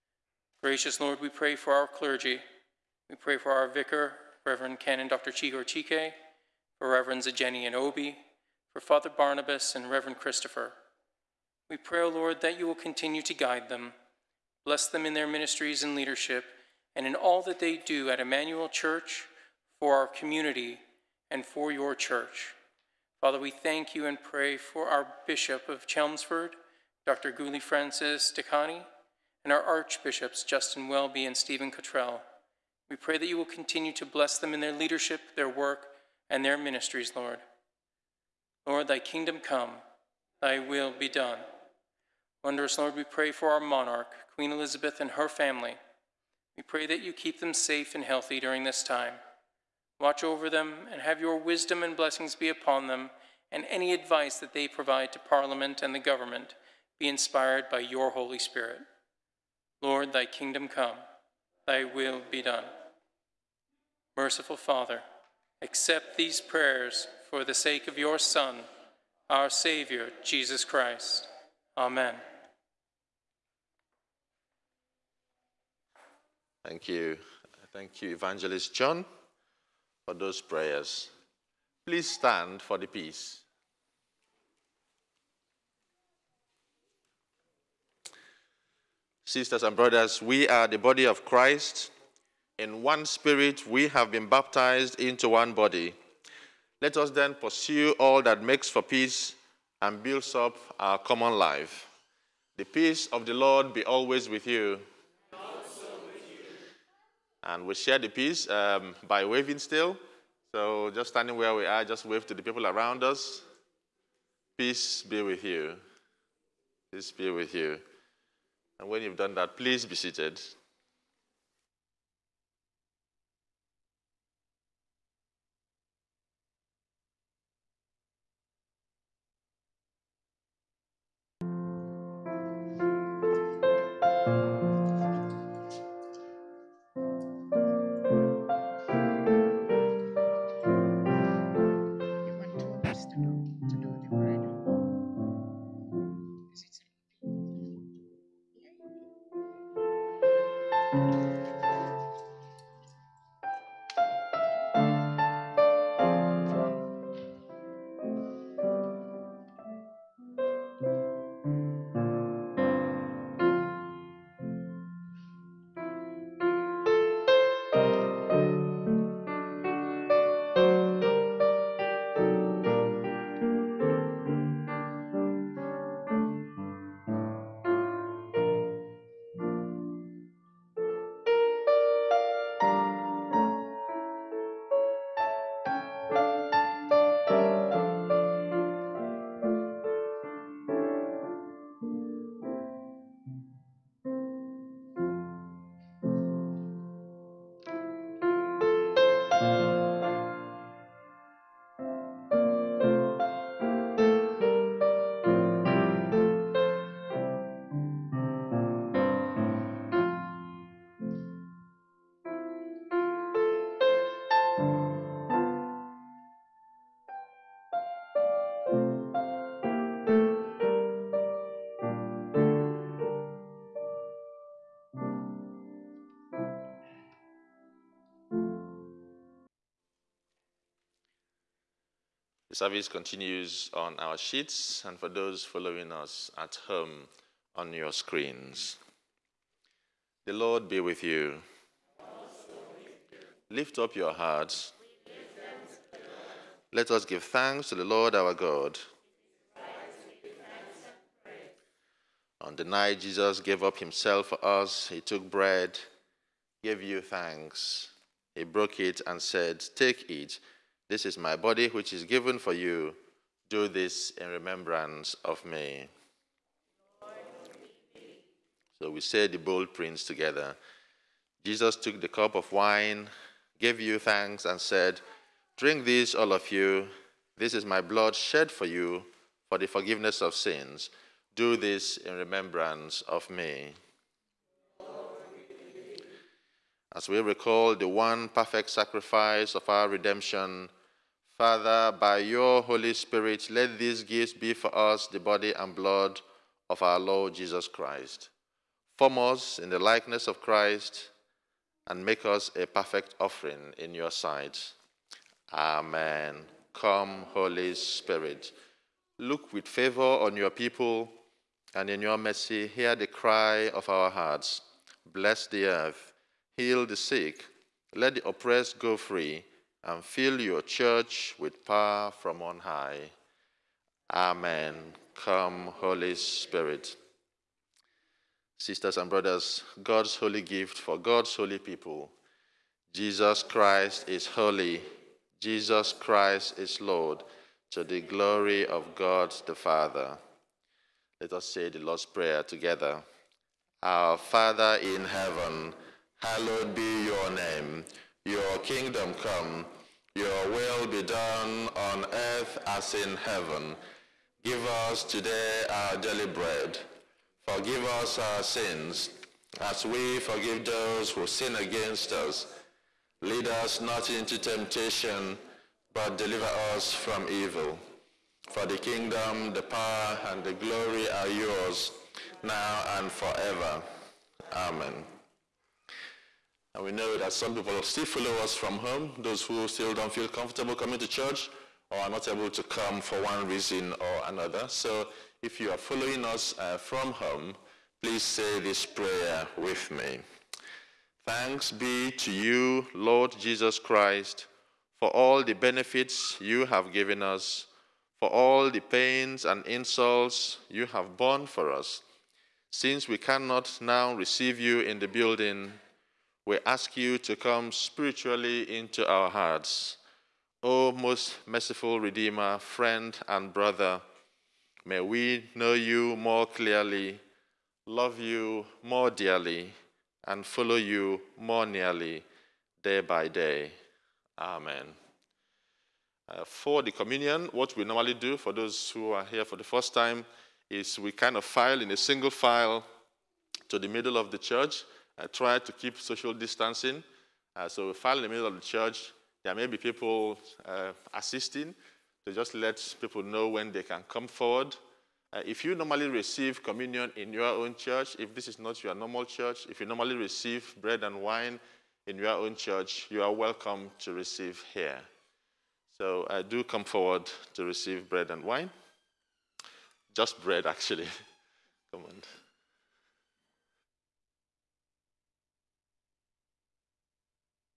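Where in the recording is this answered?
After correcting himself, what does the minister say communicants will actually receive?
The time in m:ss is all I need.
7:40.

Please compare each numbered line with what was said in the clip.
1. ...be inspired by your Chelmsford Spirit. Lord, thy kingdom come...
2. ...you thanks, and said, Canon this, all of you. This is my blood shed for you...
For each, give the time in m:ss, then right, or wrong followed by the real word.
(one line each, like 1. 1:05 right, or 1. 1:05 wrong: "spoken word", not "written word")
1. 0:56 wrong: "Holy", not "Chelmsford"
2. 4:33 wrong: "Drink", not "Canon".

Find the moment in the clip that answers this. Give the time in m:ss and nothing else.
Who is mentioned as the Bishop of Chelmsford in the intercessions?
0:27.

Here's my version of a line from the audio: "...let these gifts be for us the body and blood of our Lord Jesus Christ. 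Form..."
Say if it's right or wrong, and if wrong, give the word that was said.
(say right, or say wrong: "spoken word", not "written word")
right.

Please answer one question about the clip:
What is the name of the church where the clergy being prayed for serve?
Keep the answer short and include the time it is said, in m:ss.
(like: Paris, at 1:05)
Emmanuel Church, at 0:18.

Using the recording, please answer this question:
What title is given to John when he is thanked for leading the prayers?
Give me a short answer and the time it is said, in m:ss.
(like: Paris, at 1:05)
Evangelist, at 1:18.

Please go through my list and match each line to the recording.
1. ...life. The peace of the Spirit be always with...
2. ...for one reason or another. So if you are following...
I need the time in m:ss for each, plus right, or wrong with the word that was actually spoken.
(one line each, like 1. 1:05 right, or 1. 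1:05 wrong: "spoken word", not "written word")
1. 1:41 wrong: "Lord", not "Spirit"
2. 6:22 right.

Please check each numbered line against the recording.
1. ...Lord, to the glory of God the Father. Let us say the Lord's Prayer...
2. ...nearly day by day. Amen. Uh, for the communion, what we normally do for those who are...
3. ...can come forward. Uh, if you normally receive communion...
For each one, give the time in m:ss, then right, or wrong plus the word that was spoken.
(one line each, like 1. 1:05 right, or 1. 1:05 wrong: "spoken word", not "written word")
1. 5:36 right
2. 7:01 right
3. 7:23 right.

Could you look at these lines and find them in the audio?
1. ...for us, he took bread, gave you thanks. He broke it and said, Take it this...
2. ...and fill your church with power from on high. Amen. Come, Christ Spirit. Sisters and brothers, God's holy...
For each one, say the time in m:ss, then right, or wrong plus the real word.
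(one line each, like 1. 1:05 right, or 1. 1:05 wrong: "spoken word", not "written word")
1. 4:14 right
2. 5:19 wrong: "Holy", not "Christ".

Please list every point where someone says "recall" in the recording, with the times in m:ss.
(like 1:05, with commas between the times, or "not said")
4:47.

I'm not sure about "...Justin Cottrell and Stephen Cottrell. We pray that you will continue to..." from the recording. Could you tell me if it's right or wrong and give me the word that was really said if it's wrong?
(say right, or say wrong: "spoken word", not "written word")
wrong: "Welby", not "Cottrell".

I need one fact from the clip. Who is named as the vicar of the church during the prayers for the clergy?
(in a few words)
Reverend Canon Dr. Chigor Chike.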